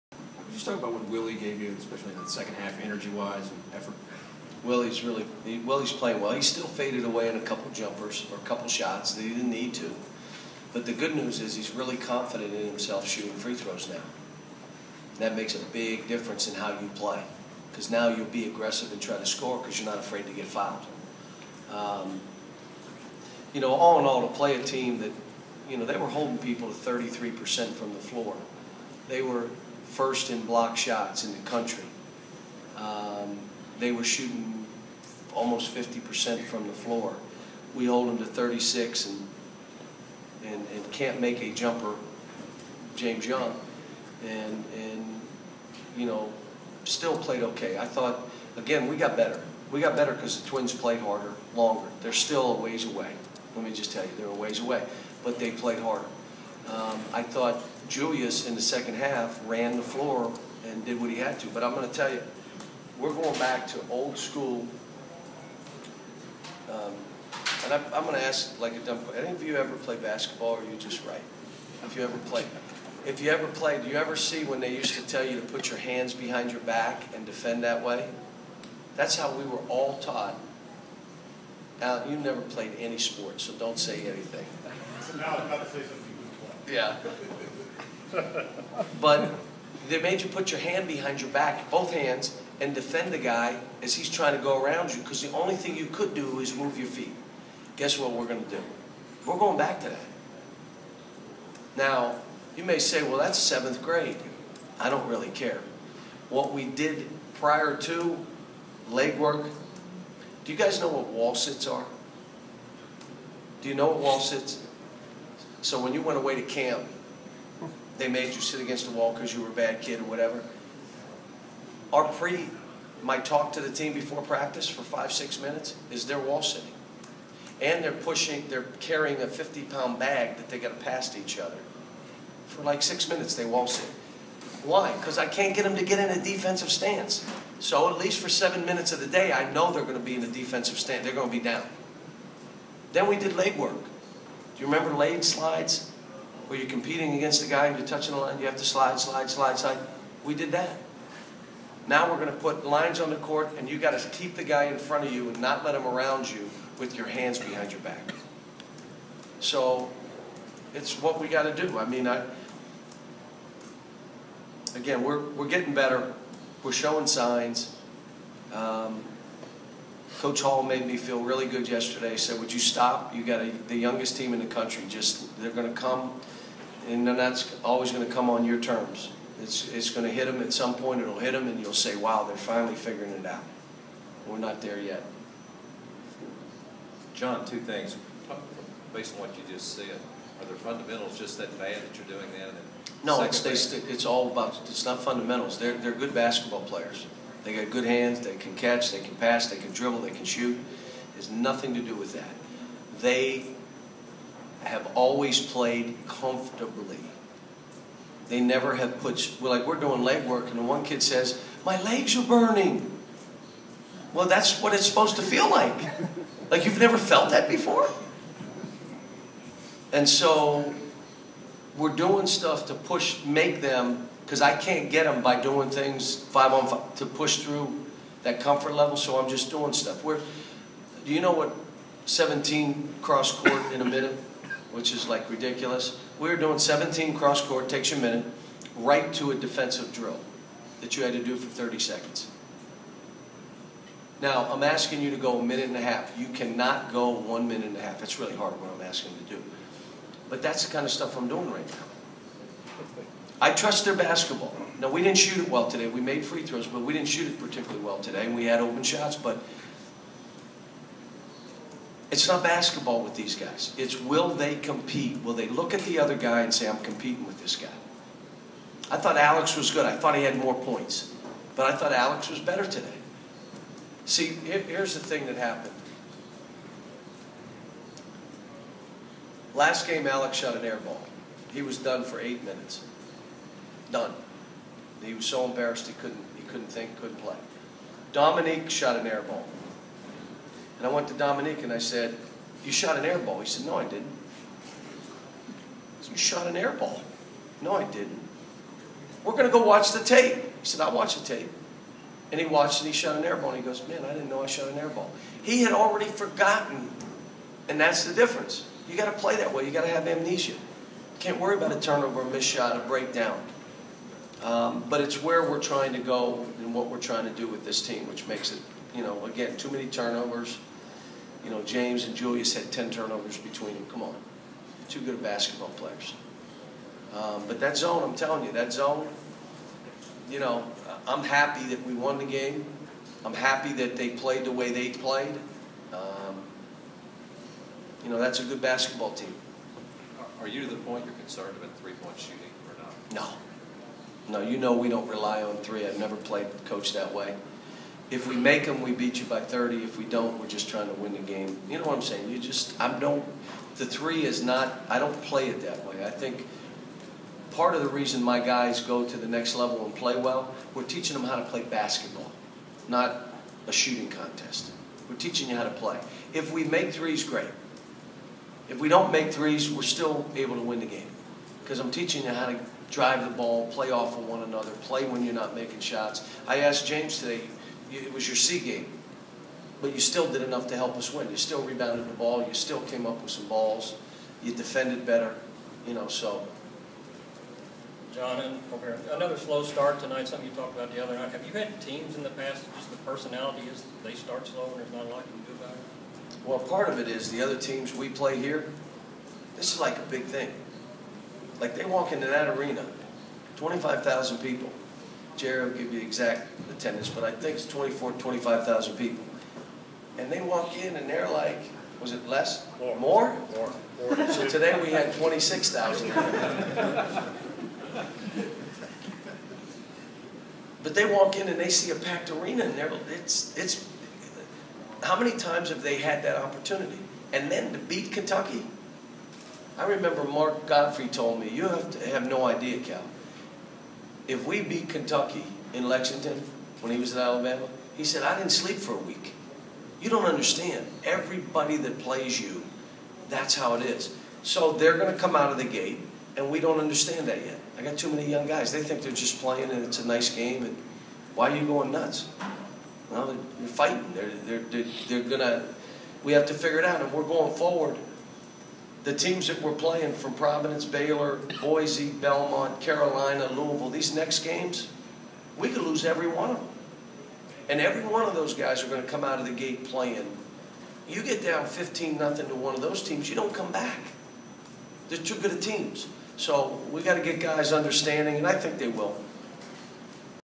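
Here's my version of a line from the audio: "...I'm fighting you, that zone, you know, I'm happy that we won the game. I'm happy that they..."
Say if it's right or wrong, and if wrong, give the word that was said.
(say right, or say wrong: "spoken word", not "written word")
wrong: "telling", not "fighting".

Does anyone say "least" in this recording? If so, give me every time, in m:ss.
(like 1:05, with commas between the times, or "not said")
2:17.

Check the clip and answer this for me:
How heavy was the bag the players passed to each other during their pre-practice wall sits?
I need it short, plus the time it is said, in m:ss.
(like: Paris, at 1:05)
50 pounds, at 2:09.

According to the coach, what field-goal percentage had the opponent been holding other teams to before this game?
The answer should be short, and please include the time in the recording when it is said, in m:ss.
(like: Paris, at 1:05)
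33%, at 0:26.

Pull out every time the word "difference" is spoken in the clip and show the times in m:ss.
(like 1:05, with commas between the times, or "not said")
0:16, 5:08.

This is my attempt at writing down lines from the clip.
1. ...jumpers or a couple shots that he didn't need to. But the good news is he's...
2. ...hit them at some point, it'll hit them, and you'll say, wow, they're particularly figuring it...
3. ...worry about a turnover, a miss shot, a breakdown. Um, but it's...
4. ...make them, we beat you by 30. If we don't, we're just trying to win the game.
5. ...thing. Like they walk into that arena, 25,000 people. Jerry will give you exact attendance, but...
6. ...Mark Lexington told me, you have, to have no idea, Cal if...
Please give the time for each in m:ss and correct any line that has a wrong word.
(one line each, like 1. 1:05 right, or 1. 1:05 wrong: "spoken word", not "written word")
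1. 0:07 right
2. 3:00 wrong: "finally", not "particularly"
3. 5:11 right
4. 5:48 right
5. 6:40 right
6. 7:10 wrong: "Gottfried", not "Lexington".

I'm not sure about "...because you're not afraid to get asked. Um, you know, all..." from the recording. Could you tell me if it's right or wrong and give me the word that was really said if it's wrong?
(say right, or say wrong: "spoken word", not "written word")
wrong: "fouled", not "asked".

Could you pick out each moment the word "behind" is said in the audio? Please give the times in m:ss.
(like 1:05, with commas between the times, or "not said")
1:16, 1:30, 2:37.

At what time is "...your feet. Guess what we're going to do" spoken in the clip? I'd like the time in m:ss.
1:36.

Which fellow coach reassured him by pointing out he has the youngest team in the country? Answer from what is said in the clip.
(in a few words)
Coach Hall.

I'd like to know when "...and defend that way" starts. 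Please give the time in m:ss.
1:17.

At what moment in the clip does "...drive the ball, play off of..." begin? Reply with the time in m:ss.
6:12.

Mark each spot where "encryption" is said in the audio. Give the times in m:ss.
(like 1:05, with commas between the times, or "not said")
not said.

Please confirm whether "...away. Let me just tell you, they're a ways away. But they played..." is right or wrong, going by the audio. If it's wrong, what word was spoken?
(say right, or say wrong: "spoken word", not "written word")
right.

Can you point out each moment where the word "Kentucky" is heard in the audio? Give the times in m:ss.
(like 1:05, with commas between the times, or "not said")
7:08, 7:14.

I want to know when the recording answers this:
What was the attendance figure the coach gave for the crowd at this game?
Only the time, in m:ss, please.
6:55.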